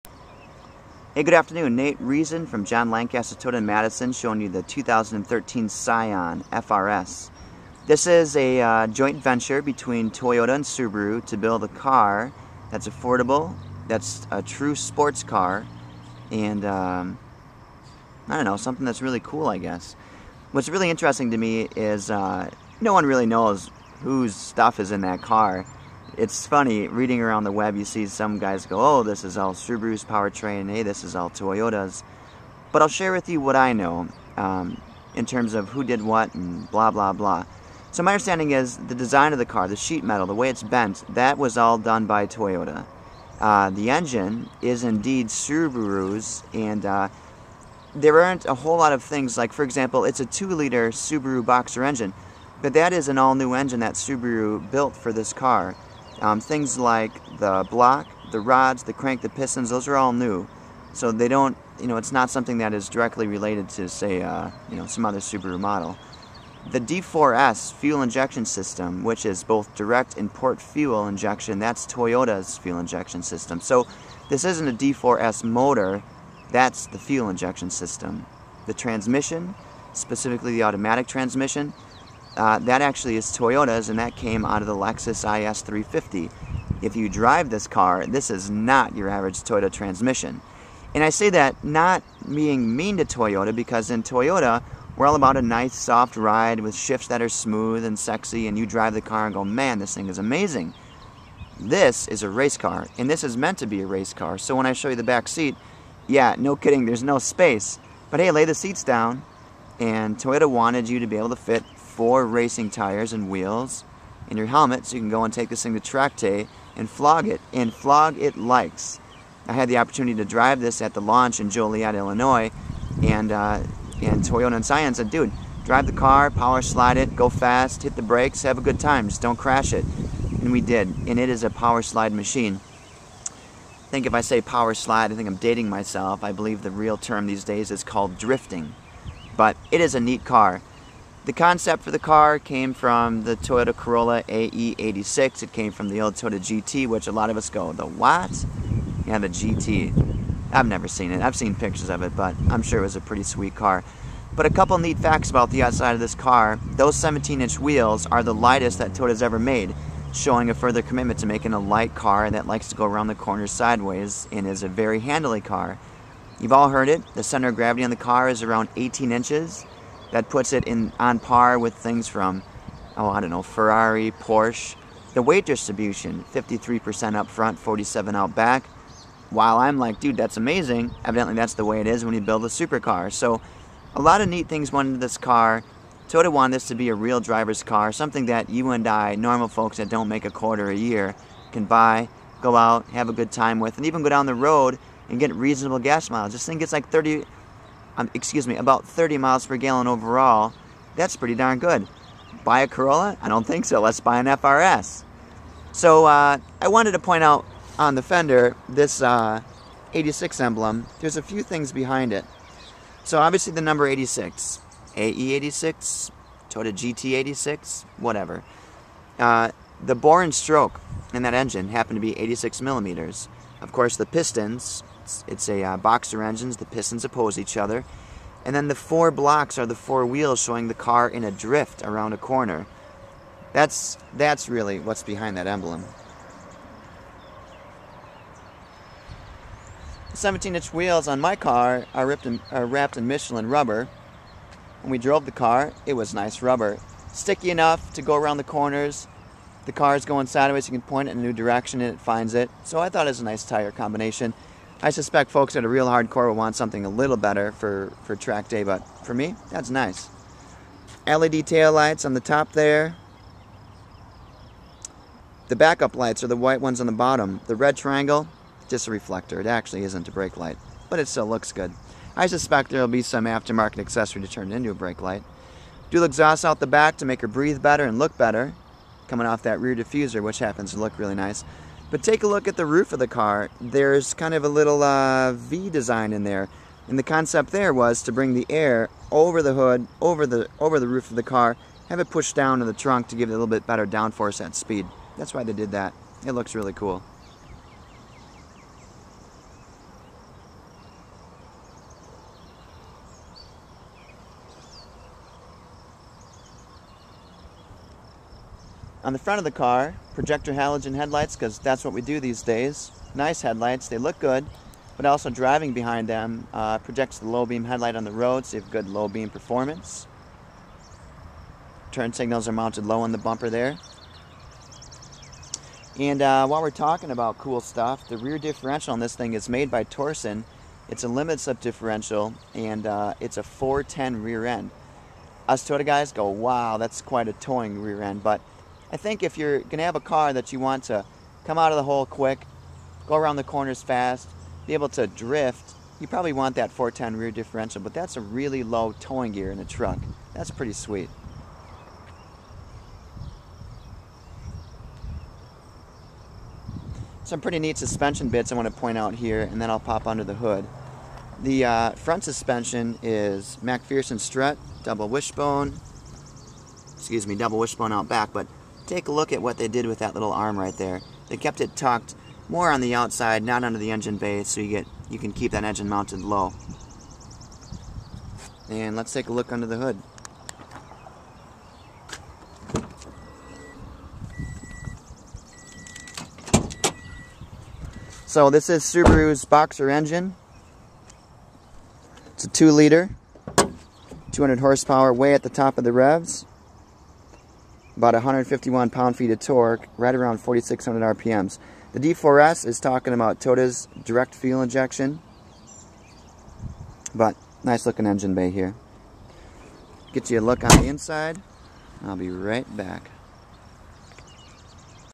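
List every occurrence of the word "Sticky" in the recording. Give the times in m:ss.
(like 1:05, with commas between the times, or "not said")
4:07.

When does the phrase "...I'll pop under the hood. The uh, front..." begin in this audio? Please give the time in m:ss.
5:59.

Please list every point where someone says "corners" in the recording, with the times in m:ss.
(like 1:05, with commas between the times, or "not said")
2:43, 3:52, 4:08, 5:43.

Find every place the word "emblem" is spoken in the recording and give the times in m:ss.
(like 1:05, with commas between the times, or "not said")
3:30, 3:55.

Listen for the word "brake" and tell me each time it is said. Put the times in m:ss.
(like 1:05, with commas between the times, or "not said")
2:08, 4:30, 4:34.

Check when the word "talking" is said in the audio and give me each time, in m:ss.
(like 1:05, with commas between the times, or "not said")
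5:26, 6:42.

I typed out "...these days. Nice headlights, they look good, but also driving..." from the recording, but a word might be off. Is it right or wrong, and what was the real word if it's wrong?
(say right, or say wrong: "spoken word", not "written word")
right.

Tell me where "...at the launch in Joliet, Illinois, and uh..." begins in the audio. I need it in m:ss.
2:00.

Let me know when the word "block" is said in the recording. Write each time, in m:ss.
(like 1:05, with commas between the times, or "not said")
0:57, 3:49.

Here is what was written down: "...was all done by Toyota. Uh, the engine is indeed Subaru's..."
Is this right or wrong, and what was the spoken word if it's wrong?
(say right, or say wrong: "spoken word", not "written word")
right.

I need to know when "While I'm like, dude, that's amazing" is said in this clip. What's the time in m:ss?
2:59.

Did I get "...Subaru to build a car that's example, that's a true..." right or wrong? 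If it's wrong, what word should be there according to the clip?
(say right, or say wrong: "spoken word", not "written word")
wrong: "affordable", not "example".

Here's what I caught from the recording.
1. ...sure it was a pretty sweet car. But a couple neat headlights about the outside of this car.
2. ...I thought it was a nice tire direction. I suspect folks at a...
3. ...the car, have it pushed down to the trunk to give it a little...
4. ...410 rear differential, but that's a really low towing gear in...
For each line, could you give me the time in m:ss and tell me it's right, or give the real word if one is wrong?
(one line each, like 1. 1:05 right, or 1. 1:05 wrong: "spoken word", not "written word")
1. 2:32 wrong: "facts", not "headlights"
2. 4:12 wrong: "combination", not "direction"
3. 4:51 right
4. 5:46 right.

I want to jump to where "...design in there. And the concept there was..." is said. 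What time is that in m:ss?
4:45.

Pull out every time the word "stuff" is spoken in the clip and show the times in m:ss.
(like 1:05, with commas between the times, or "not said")
0:24, 5:27.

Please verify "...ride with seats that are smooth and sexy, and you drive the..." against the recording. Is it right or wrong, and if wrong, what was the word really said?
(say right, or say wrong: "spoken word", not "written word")
wrong: "shifts", not "seats".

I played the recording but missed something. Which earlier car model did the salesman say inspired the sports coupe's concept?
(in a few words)
Toyota Corolla AE86.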